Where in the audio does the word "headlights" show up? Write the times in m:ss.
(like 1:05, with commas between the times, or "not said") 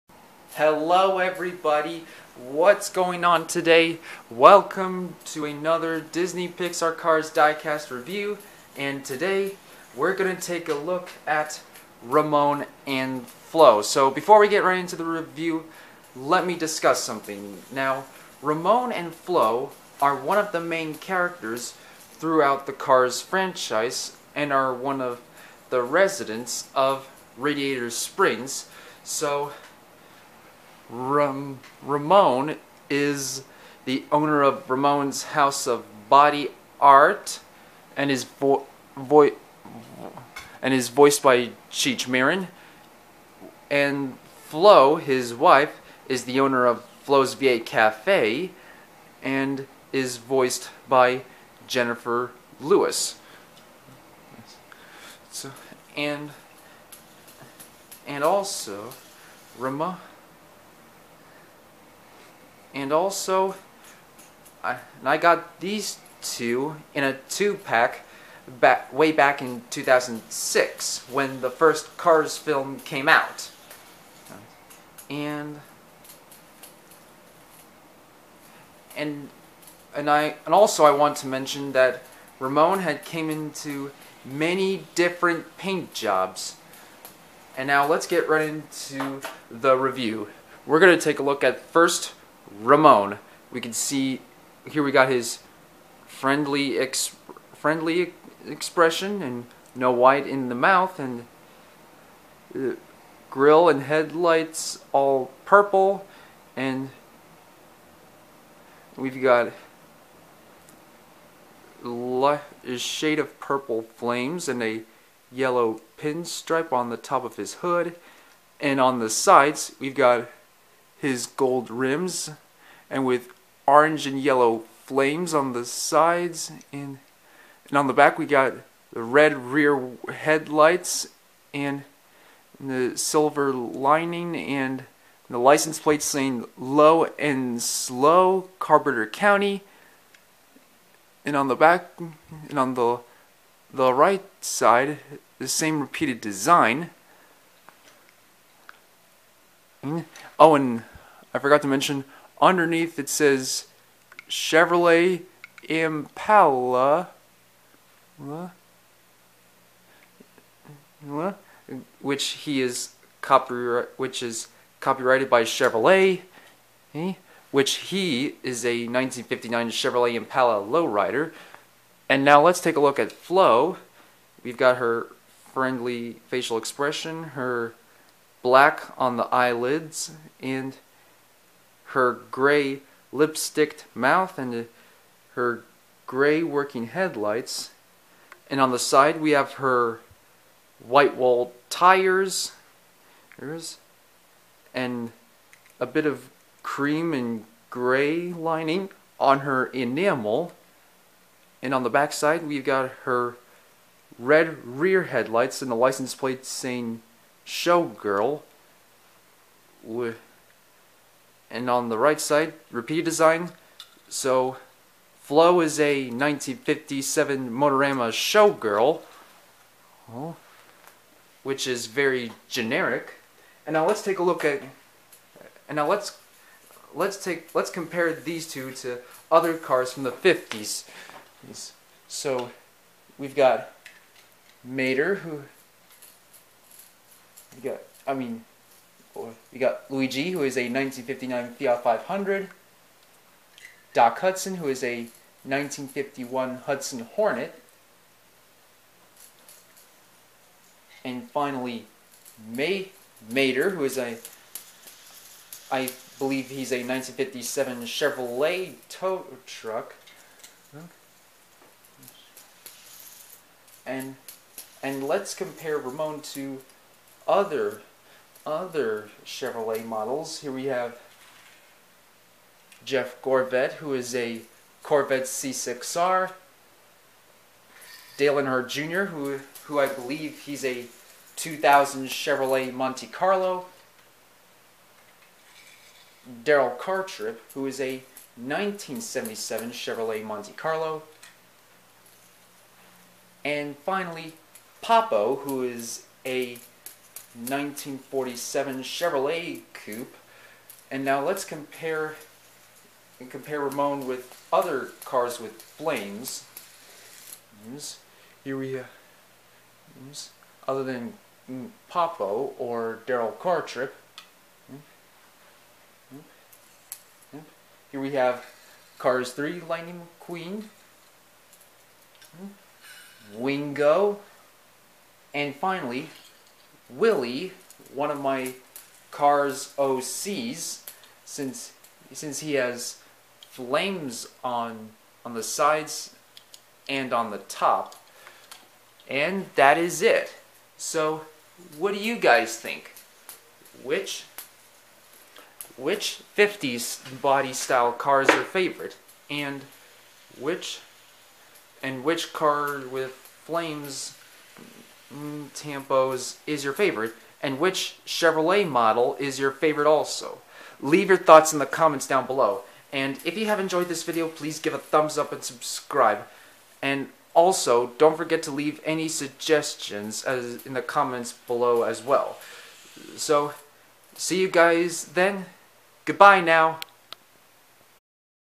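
1:43, 2:10, 3:06, 3:25.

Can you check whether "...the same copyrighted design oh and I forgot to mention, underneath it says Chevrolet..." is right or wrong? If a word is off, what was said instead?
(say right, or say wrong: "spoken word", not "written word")
wrong: "repeated", not "copyrighted".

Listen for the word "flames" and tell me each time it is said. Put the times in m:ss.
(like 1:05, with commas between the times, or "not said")
1:53, 2:04, 5:05, 5:33, 5:53.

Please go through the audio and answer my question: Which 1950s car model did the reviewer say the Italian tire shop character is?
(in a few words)
1959 Fiat 500.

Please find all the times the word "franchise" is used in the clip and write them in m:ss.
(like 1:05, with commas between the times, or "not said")
0:23.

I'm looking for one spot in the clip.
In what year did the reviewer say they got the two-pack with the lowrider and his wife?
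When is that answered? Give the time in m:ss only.
1:09.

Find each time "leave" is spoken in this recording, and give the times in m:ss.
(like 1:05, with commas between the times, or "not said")
6:00, 6:08.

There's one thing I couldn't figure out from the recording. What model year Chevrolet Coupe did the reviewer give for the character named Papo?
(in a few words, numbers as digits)
1947.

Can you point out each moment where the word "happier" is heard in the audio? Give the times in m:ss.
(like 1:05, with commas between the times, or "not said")
not said.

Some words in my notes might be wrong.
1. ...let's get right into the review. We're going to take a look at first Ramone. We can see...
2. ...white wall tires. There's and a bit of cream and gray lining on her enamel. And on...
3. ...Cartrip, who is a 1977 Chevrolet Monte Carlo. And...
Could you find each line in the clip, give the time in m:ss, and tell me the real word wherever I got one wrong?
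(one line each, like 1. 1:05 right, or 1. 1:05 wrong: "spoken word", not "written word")
1. 1:27 right
2. 3:10 right
3. 4:46 right.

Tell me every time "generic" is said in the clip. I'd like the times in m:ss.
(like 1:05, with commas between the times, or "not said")
3:42.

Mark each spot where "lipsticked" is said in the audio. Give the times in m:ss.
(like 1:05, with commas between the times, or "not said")
3:03.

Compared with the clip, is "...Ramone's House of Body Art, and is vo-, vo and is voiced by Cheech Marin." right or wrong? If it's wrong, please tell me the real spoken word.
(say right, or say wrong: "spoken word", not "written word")
right.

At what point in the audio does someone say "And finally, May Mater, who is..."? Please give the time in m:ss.
4:11.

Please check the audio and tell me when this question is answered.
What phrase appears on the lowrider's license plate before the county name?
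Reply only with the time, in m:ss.
2:16.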